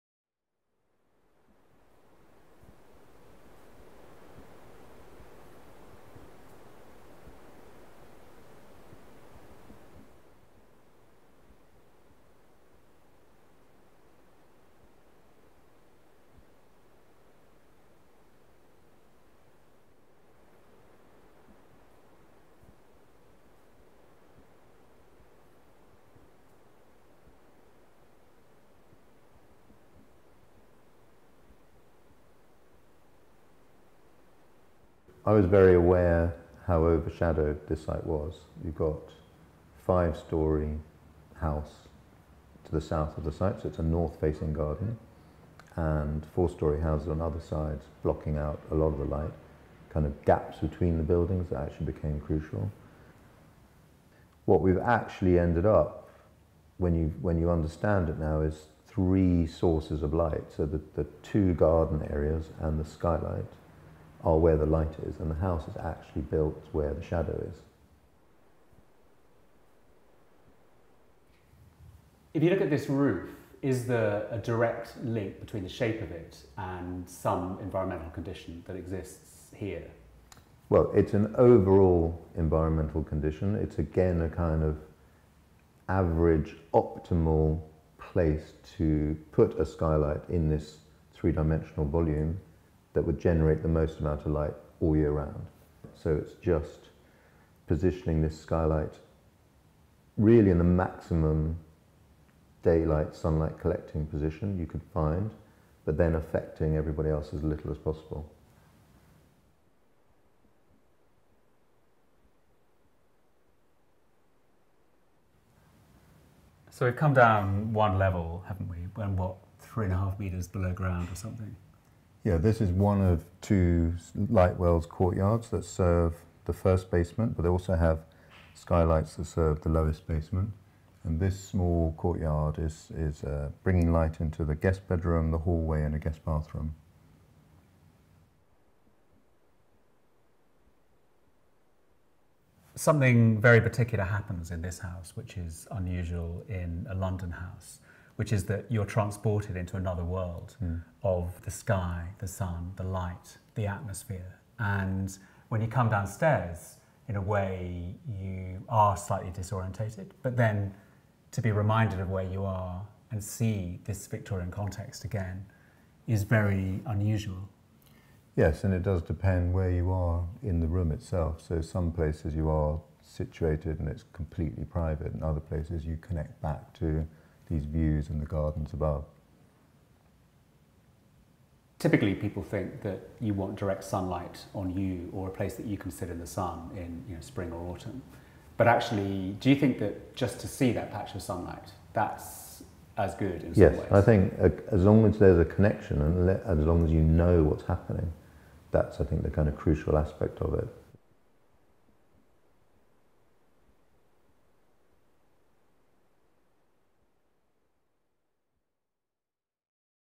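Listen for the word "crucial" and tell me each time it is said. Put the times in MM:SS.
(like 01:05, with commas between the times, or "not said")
00:52, 03:19.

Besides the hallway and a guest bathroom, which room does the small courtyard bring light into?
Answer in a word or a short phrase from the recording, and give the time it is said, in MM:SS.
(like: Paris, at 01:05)
Guest bedroom, at 02:14.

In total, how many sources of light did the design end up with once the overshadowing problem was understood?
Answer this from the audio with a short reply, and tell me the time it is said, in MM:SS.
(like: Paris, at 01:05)
3, at 00:58.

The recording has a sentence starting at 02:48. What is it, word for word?
Yes, and it does depend where you are in the room itself.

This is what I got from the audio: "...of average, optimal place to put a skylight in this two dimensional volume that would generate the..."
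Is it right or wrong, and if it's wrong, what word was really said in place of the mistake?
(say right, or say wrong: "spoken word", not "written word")
wrong: "three", not "two".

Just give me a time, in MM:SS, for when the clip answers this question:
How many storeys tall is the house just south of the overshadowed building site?
00:39.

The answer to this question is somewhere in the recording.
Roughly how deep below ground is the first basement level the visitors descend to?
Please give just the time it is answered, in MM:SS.
01:59.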